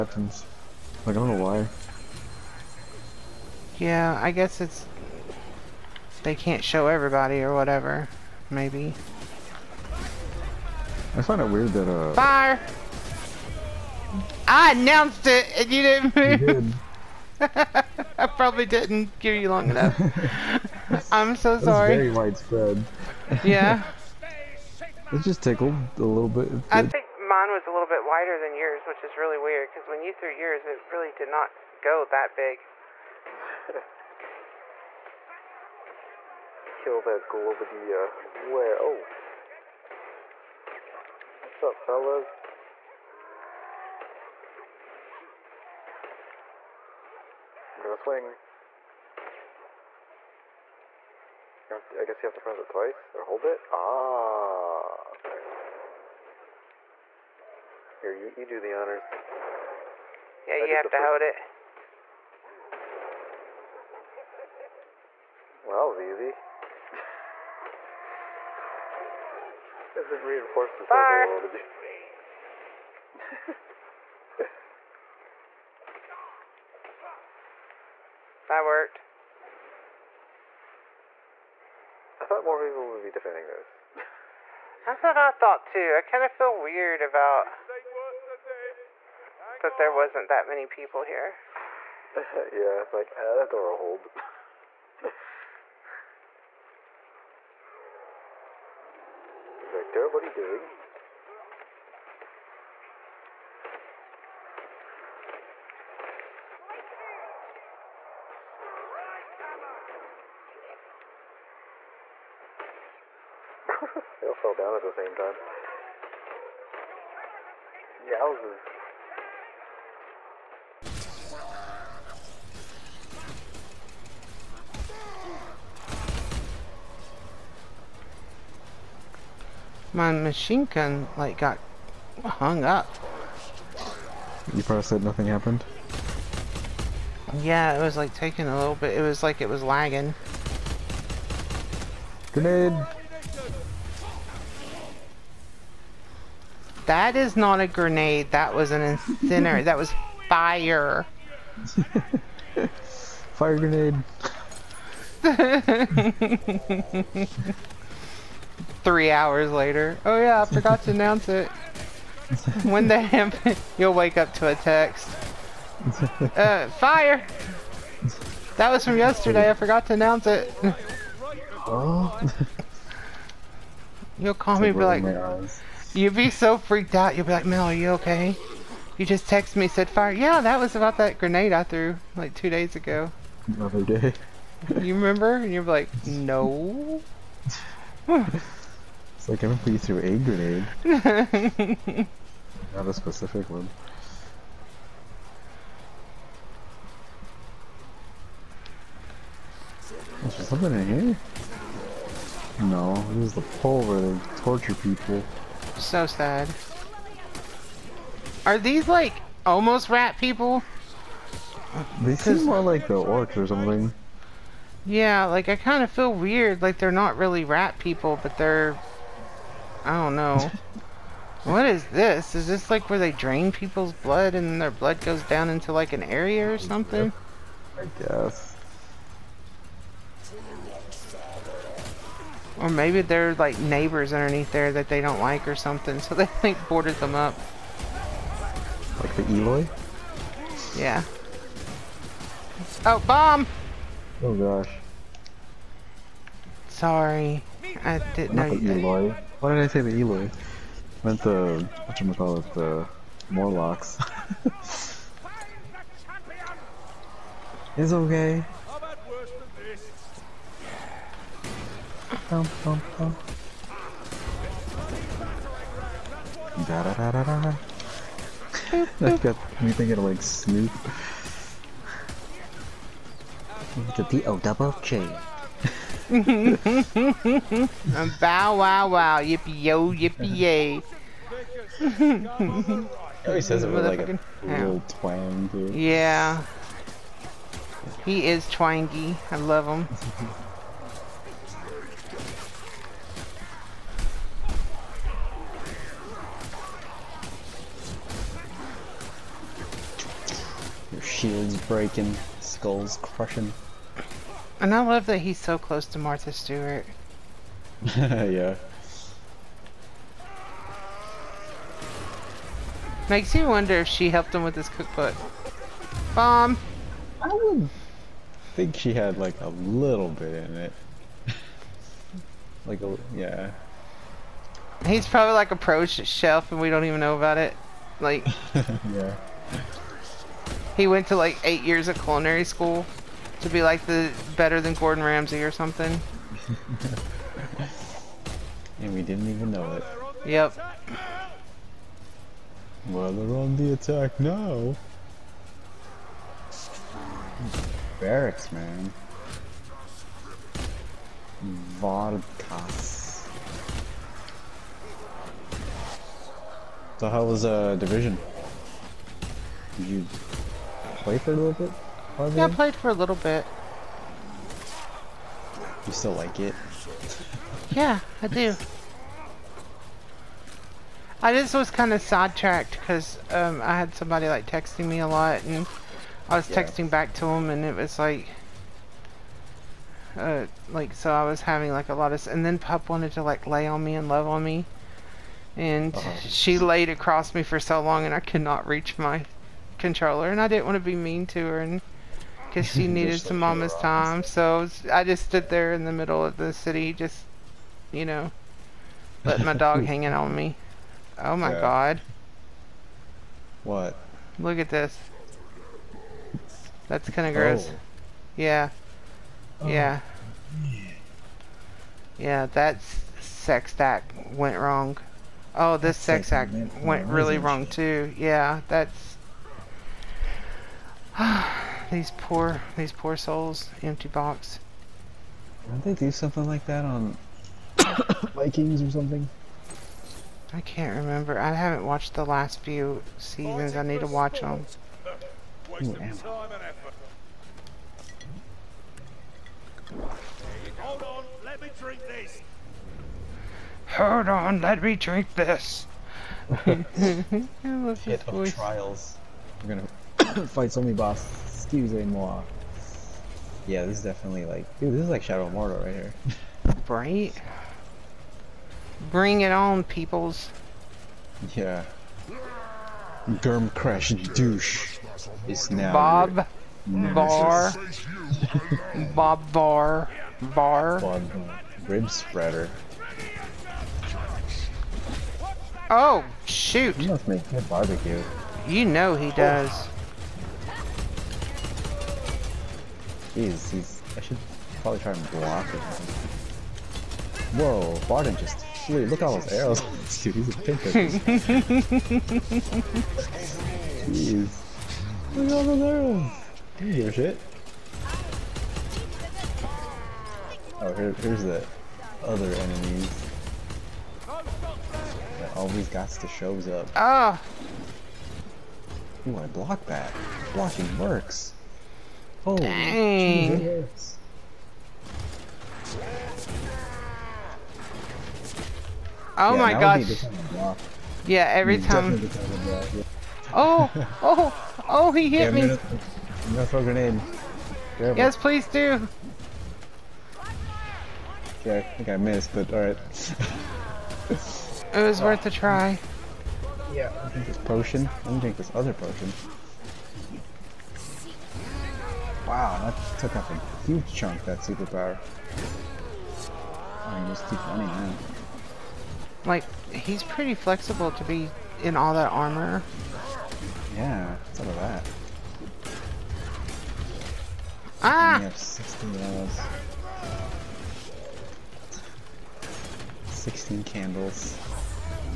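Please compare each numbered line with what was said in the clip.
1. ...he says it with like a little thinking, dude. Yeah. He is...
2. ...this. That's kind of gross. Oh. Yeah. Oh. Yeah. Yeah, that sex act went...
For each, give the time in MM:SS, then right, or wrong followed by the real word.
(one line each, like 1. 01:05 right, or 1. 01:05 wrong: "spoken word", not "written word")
1. 04:43 wrong: "twang", not "thinking"
2. 06:44 right.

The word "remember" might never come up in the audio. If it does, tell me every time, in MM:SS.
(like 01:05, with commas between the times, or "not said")
03:04, 03:09, 07:10.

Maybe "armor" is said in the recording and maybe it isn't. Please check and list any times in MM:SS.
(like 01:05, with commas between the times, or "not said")
09:12.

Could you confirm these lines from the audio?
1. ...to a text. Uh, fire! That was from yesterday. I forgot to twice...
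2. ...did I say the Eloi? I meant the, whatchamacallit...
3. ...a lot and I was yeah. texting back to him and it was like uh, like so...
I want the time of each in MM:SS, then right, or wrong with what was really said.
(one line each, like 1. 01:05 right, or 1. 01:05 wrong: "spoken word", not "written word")
1. 02:44 wrong: "announce", not "twice"
2. 04:09 right
3. 06:15 right.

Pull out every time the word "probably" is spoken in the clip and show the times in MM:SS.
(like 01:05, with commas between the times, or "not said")
00:18, 02:14, 05:25, 08:04.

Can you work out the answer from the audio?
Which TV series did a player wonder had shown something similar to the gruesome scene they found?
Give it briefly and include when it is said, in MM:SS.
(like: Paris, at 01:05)
Vikings, at 07:08.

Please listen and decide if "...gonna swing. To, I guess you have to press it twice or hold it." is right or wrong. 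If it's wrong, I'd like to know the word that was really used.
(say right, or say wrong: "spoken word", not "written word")
right.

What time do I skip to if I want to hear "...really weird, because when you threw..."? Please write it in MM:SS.
00:29.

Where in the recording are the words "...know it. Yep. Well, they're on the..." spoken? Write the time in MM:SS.
05:39.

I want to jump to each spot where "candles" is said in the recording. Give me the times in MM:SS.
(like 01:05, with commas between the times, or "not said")
09:23.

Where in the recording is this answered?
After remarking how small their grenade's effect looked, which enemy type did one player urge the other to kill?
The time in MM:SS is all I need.
00:37.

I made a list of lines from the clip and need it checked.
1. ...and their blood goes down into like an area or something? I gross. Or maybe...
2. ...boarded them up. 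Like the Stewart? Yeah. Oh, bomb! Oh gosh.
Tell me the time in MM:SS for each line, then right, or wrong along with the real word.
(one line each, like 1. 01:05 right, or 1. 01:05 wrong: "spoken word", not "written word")
1. 03:44 wrong: "guess", not "gross"
2. 03:56 wrong: "Eloi", not "Stewart".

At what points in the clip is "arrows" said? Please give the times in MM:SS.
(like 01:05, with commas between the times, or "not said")
08:09, 08:15.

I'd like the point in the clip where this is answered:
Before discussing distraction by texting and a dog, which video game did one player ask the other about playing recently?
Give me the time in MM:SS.
05:57.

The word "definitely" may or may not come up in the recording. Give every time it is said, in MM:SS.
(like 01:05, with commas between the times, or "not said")
07:34.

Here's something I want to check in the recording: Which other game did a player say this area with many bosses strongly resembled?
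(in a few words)
Shadow of Mordor.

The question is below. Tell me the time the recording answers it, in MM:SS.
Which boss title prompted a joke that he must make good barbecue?
07:51.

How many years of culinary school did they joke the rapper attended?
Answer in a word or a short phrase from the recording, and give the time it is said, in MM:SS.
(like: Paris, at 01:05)
8, at 05:31.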